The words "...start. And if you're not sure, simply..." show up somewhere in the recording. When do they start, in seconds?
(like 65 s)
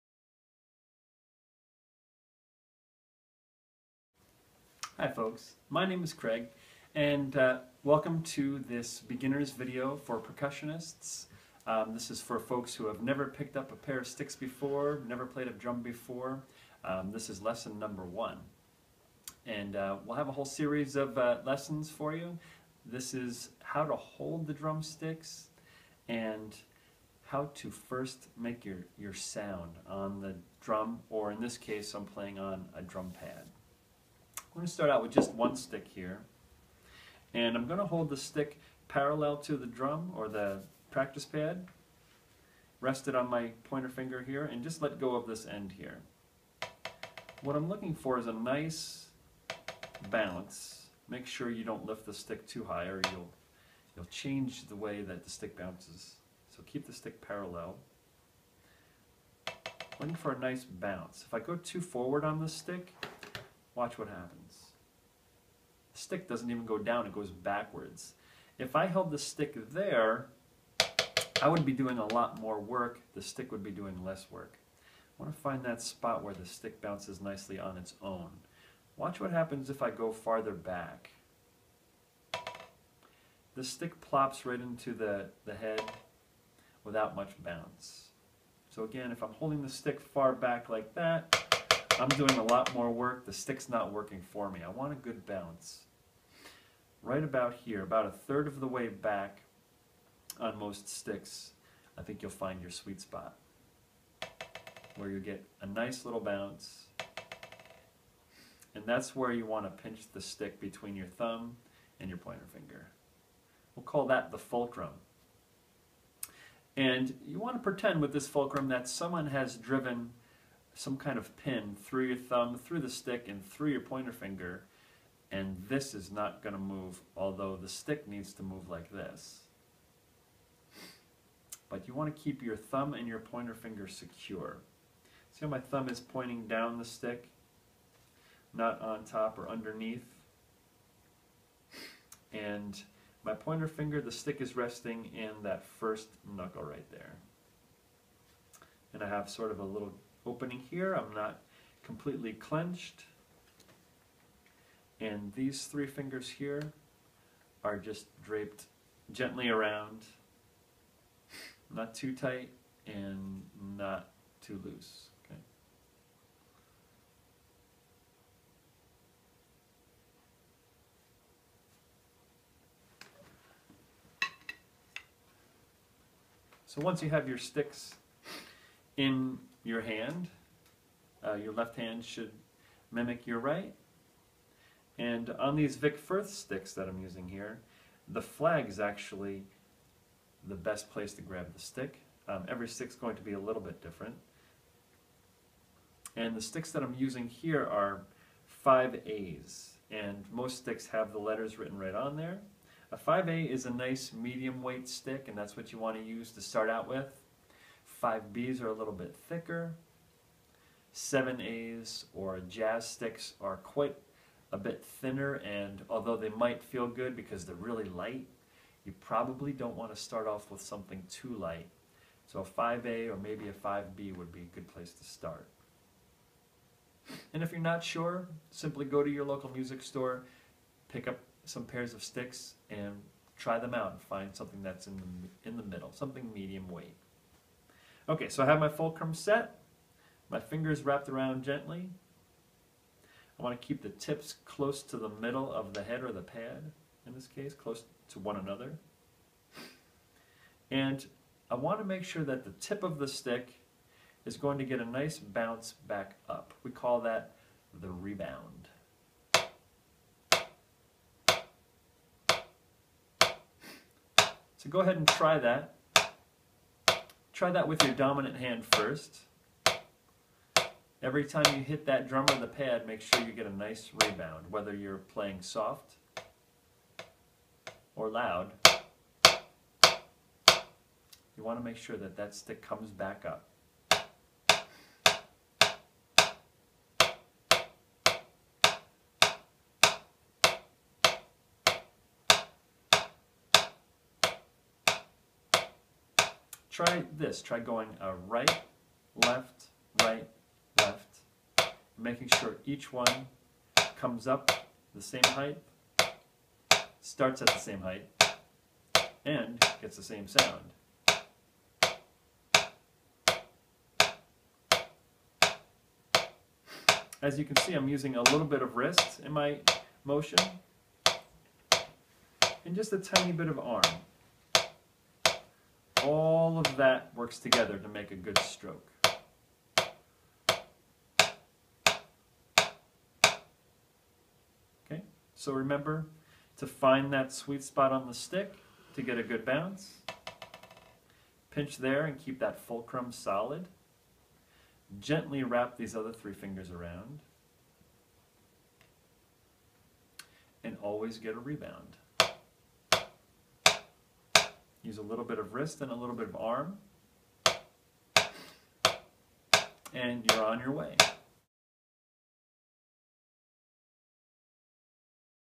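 225 s.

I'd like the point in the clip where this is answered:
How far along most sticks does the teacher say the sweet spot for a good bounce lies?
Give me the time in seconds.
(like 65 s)
98 s.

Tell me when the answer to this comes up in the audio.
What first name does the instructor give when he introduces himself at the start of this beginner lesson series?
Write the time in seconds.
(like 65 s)
6 s.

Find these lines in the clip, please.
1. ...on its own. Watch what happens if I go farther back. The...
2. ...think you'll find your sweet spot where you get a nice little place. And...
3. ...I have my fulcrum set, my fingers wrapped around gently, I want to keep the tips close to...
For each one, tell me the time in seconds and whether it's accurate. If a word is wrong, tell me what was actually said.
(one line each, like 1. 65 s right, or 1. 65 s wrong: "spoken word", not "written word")
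1. 77 s right
2. 102 s wrong: "bounce", not "place"
3. 238 s right.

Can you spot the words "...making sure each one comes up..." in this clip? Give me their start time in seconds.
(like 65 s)
302 s.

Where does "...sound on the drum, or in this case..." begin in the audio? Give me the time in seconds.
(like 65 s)
29 s.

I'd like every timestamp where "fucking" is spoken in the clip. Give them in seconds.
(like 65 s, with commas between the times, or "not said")
not said.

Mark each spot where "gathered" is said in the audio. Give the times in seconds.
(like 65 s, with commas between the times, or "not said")
not said.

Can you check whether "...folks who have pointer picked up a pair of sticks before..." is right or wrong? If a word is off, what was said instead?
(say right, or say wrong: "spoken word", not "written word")
wrong: "never", not "pointer".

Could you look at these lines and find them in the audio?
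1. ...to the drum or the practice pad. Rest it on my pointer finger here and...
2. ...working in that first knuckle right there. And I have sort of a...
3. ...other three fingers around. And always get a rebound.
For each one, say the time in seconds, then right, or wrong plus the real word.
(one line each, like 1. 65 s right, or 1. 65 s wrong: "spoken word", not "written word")
1. 39 s right
2. 144 s wrong: "resting", not "working"
3. 345 s right.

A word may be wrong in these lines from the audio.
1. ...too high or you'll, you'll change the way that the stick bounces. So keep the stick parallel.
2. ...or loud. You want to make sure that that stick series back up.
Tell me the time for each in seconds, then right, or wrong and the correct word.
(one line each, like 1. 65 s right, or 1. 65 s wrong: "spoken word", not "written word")
1. 52 s right
2. 277 s wrong: "comes", not "series".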